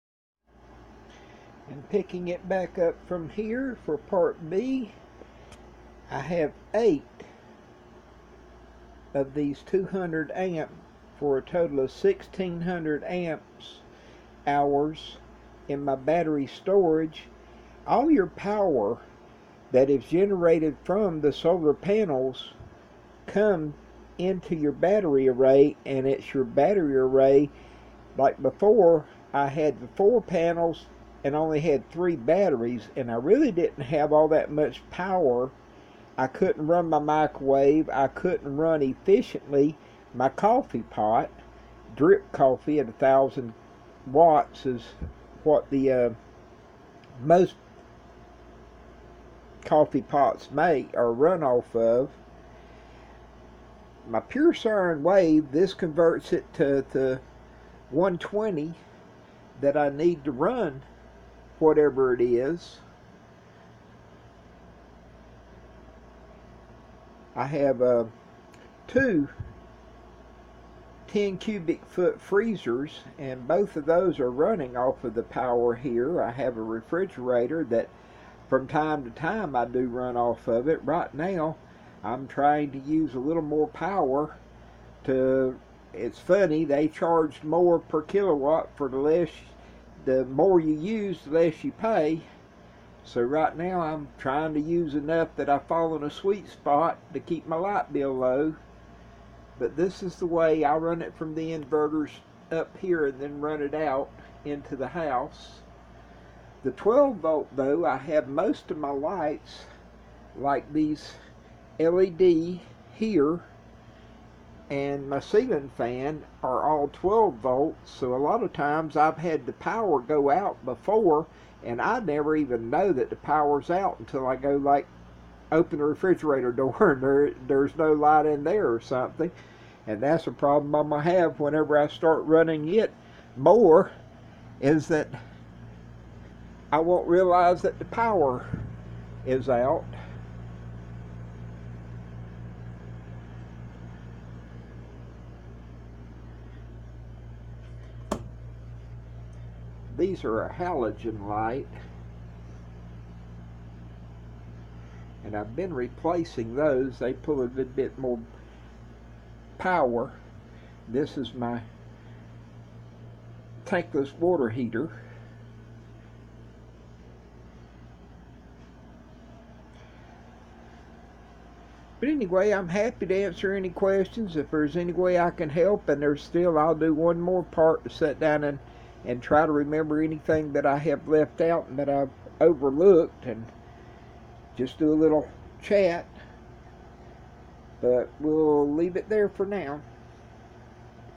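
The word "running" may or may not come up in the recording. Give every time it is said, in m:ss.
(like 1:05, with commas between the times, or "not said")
1:14, 2:12.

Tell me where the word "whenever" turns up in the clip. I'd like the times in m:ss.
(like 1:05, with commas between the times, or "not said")
2:11.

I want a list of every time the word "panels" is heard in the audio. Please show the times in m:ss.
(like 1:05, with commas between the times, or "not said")
0:21, 0:30.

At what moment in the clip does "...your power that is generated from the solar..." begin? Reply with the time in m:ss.
0:18.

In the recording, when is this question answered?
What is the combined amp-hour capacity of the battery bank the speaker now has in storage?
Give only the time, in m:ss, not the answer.
0:11.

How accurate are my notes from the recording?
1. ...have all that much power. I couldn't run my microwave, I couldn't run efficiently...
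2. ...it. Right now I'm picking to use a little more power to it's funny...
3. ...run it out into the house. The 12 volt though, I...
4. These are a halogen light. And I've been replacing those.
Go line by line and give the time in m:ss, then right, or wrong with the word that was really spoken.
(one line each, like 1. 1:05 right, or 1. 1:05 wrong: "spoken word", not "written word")
1. 0:33 right
2. 1:20 wrong: "trying", not "picking"
3. 1:43 right
4. 2:30 right.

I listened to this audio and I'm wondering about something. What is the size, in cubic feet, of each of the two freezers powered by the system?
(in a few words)
10 cubic feet.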